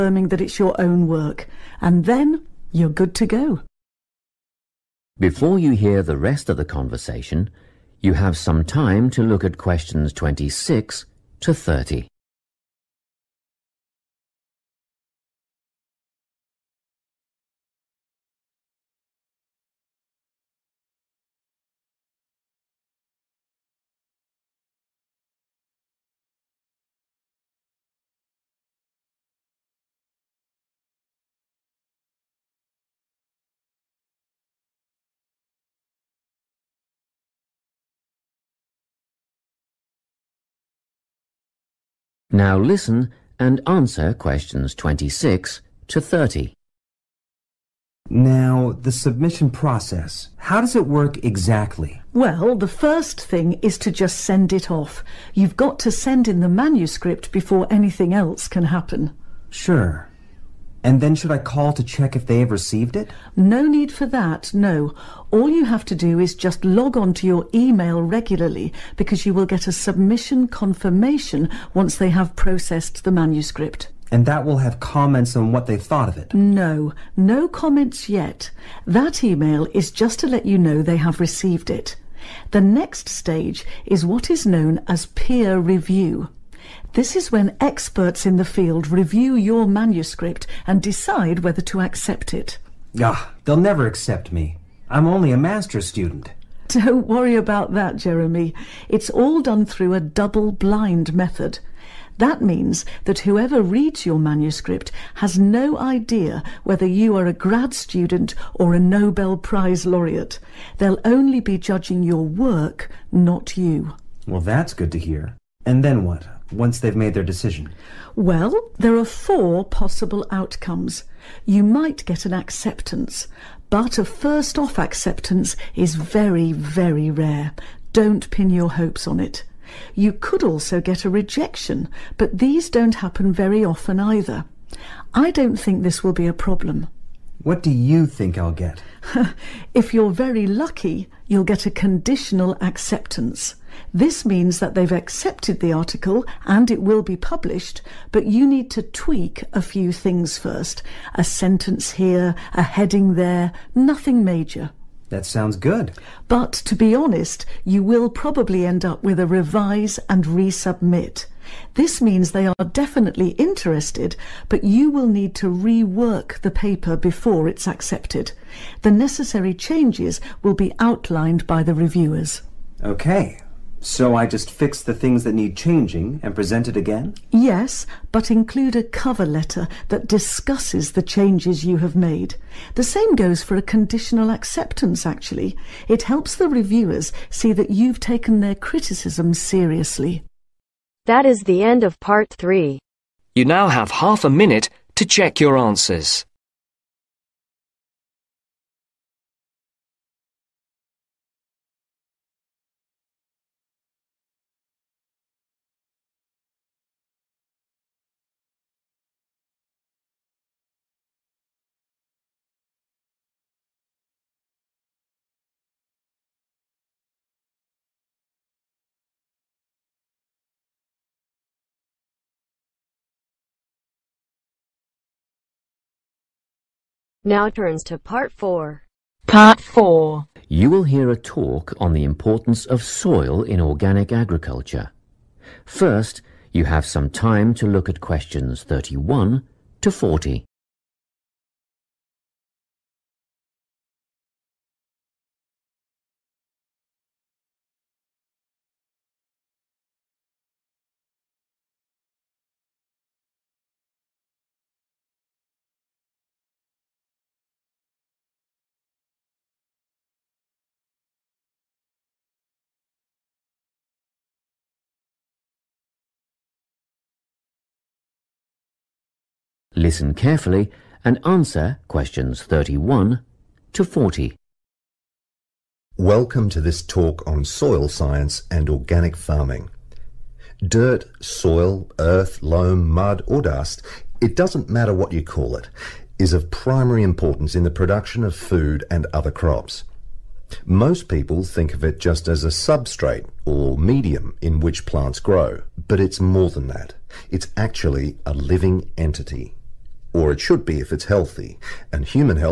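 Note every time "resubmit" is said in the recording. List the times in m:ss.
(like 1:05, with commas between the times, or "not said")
2:40.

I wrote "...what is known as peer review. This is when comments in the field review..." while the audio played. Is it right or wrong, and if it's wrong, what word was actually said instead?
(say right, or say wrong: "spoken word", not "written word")
wrong: "experts", not "comments".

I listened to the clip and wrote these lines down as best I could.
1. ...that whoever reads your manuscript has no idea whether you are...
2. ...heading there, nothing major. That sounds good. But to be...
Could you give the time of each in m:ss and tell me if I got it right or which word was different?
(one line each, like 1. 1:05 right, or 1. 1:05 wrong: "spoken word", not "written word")
1. 1:43 right
2. 2:32 right.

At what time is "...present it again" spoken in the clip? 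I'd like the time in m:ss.
2:56.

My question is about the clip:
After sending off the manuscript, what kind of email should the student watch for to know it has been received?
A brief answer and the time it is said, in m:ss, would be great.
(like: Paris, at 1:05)
submission confirmation, at 1:09.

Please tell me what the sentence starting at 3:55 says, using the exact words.
First, you have some time to look at questions 31 to 40.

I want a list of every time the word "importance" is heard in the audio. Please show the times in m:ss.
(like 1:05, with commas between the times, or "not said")
3:52, 4:47.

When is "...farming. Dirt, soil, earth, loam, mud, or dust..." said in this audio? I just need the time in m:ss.
4:39.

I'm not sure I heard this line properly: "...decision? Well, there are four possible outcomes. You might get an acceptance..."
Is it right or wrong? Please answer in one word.
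right.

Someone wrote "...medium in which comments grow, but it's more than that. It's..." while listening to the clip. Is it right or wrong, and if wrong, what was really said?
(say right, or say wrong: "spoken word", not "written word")
wrong: "plants", not "comments".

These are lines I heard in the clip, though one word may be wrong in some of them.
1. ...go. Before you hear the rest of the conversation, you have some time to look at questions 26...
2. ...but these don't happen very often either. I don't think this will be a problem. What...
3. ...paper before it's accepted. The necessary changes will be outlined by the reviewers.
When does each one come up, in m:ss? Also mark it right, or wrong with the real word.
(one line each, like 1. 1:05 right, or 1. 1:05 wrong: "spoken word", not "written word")
1. 0:03 right
2. 2:12 right
3. 2:46 right.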